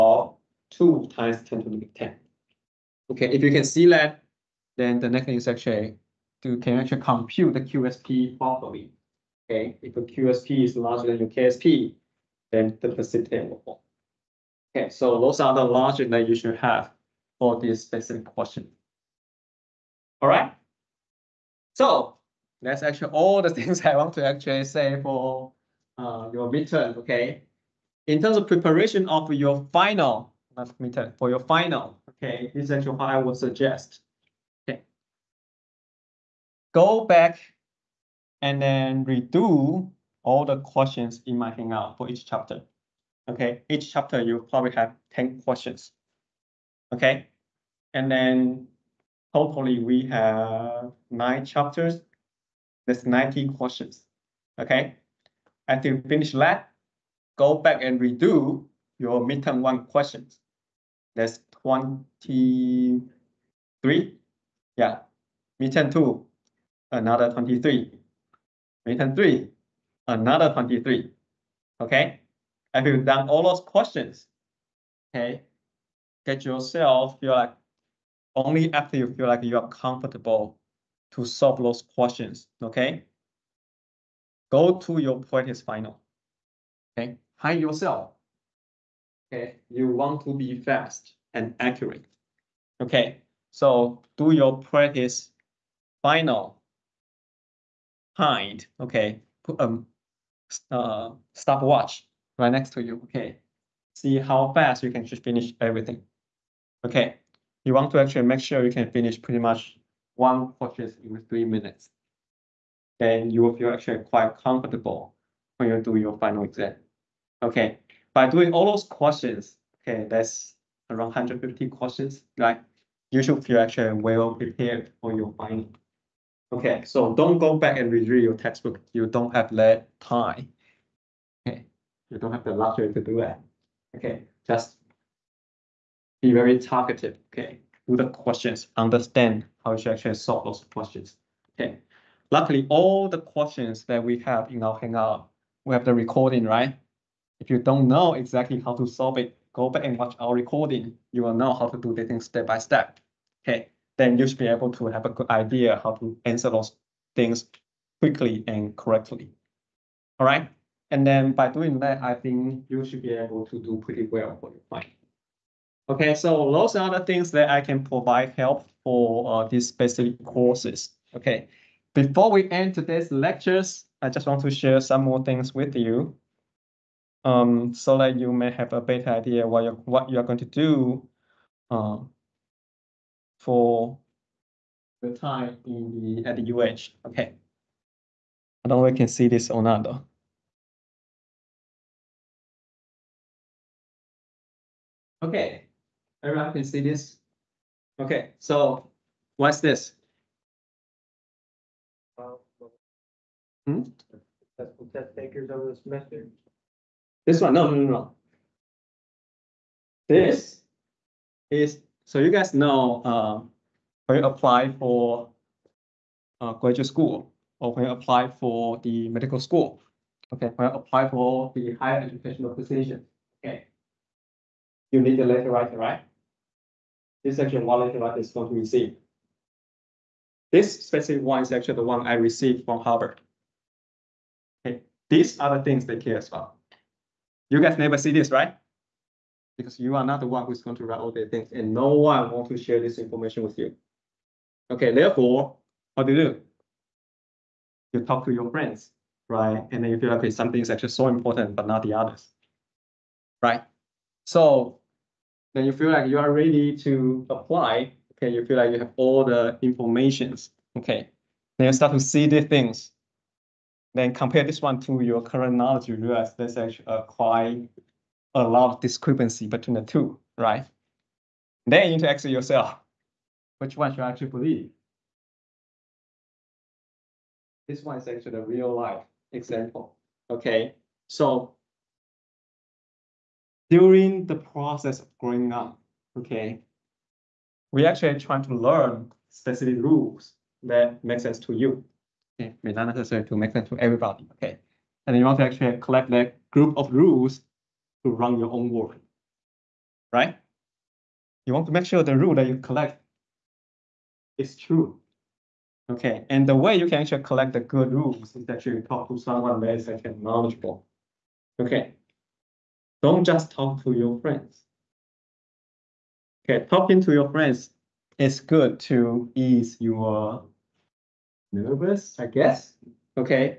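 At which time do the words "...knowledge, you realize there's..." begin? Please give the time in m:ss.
4:25.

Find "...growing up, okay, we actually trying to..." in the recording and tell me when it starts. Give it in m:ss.
4:45.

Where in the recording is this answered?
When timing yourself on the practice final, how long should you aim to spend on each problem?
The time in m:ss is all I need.
1:51.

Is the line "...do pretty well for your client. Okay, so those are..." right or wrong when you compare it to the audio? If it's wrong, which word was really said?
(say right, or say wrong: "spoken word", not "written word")
right.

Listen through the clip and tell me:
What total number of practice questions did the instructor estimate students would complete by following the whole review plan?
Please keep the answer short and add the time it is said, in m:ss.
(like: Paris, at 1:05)
150, at 2:01.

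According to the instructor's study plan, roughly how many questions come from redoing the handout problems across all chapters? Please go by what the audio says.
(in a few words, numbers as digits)
90.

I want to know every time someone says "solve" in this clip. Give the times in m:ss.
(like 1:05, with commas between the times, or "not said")
1:21, 2:20, 2:28.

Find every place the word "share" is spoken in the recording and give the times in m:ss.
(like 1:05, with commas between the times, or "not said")
2:54, 4:02.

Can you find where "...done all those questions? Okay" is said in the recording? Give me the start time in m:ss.
1:13.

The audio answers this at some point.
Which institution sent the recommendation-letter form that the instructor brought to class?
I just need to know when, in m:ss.
3:52.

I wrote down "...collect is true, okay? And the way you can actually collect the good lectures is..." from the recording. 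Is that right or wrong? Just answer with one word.
wrong.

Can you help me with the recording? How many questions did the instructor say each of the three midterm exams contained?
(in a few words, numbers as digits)
23.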